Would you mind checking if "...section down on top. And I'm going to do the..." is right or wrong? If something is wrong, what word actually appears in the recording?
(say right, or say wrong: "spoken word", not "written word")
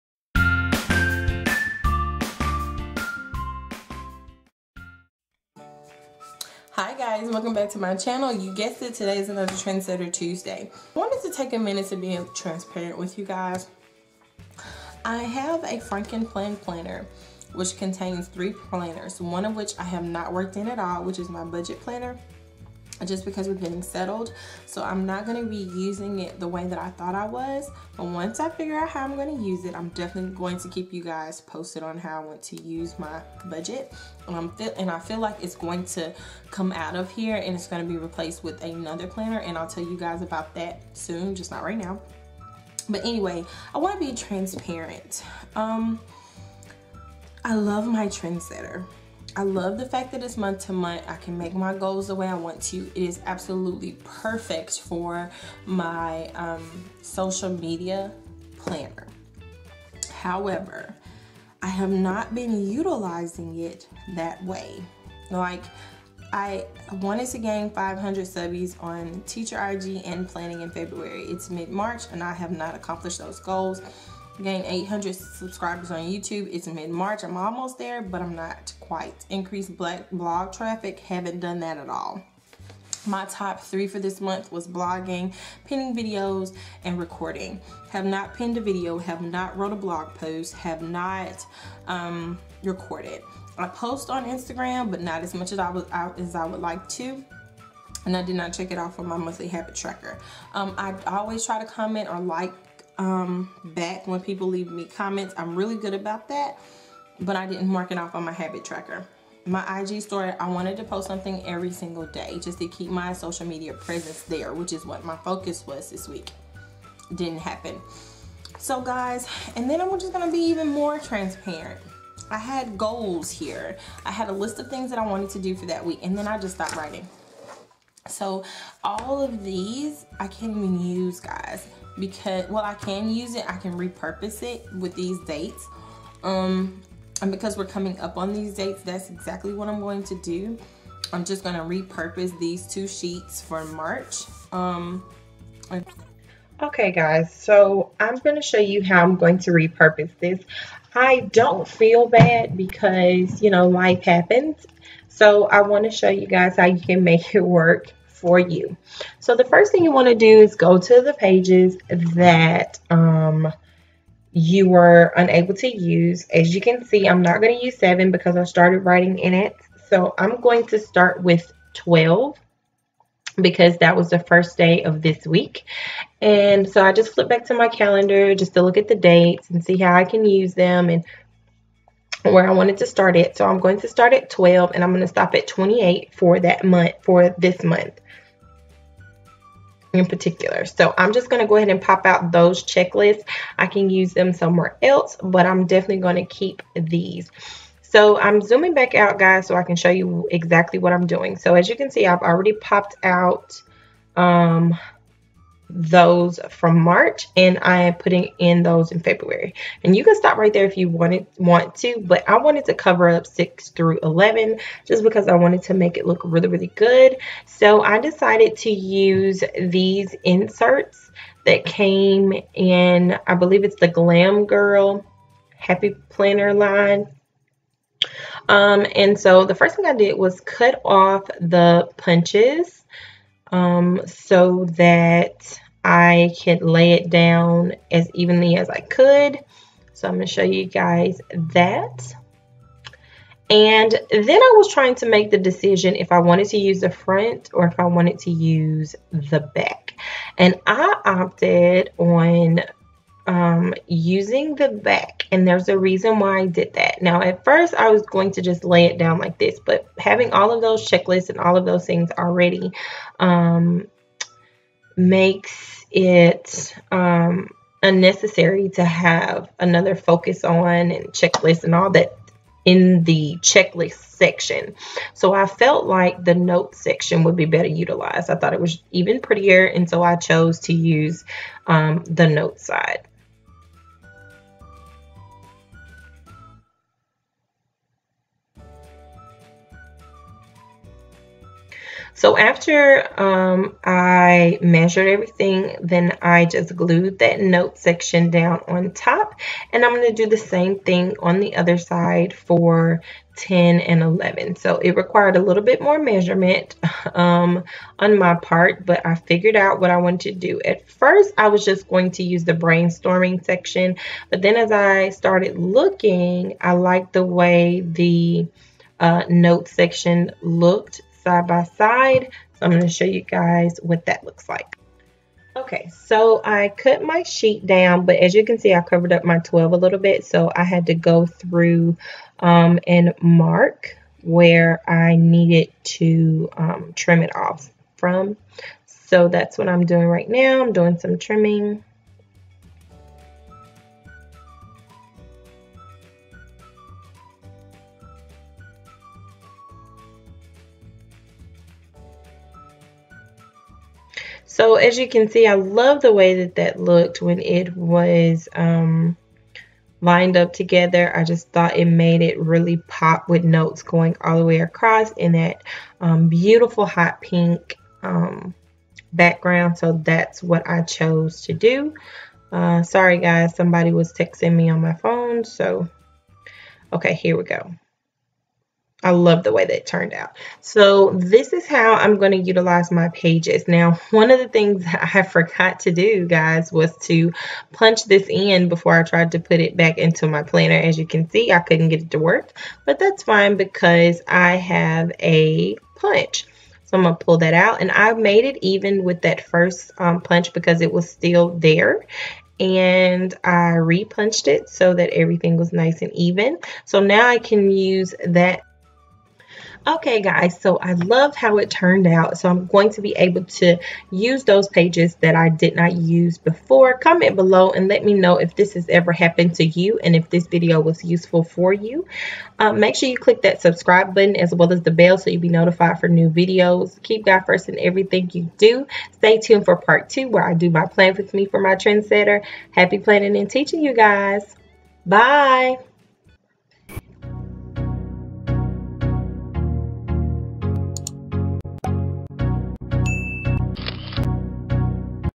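right.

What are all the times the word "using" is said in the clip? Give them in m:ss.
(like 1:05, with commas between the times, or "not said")
0:25, 4:13.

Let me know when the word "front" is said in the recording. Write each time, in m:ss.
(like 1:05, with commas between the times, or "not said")
4:06.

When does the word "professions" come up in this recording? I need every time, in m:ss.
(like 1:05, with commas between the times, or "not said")
not said.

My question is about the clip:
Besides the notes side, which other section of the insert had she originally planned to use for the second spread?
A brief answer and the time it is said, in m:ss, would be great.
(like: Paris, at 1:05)
brainstorming section, at 5:12.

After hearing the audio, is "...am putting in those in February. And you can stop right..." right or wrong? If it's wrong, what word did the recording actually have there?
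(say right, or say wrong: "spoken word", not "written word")
right.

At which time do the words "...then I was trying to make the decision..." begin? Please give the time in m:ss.
4:03.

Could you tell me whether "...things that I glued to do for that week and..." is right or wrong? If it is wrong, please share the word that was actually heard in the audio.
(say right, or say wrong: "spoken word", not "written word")
wrong: "wanted", not "glued".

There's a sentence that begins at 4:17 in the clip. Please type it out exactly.
Now, at first, I was going to just lay it down like this.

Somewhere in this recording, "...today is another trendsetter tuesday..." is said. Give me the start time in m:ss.
0:08.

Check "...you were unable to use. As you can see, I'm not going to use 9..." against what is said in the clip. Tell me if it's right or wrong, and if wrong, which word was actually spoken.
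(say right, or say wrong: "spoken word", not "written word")
wrong: "7", not "9".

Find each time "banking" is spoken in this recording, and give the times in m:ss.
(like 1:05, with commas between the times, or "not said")
not said.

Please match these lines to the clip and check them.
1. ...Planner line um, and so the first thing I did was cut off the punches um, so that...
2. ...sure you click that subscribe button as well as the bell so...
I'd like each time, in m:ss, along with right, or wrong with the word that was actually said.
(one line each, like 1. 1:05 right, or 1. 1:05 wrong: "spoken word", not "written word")
1. 3:46 right
2. 7:02 right.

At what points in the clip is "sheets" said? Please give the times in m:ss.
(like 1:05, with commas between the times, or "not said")
2:22, 5:27.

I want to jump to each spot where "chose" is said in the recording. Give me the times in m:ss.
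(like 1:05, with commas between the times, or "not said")
4:40, 6:10.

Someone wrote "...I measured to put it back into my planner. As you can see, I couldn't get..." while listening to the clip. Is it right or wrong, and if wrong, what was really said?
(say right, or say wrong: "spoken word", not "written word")
wrong: "tried", not "measured".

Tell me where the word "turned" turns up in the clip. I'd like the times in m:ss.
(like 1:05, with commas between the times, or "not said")
6:19, 6:51.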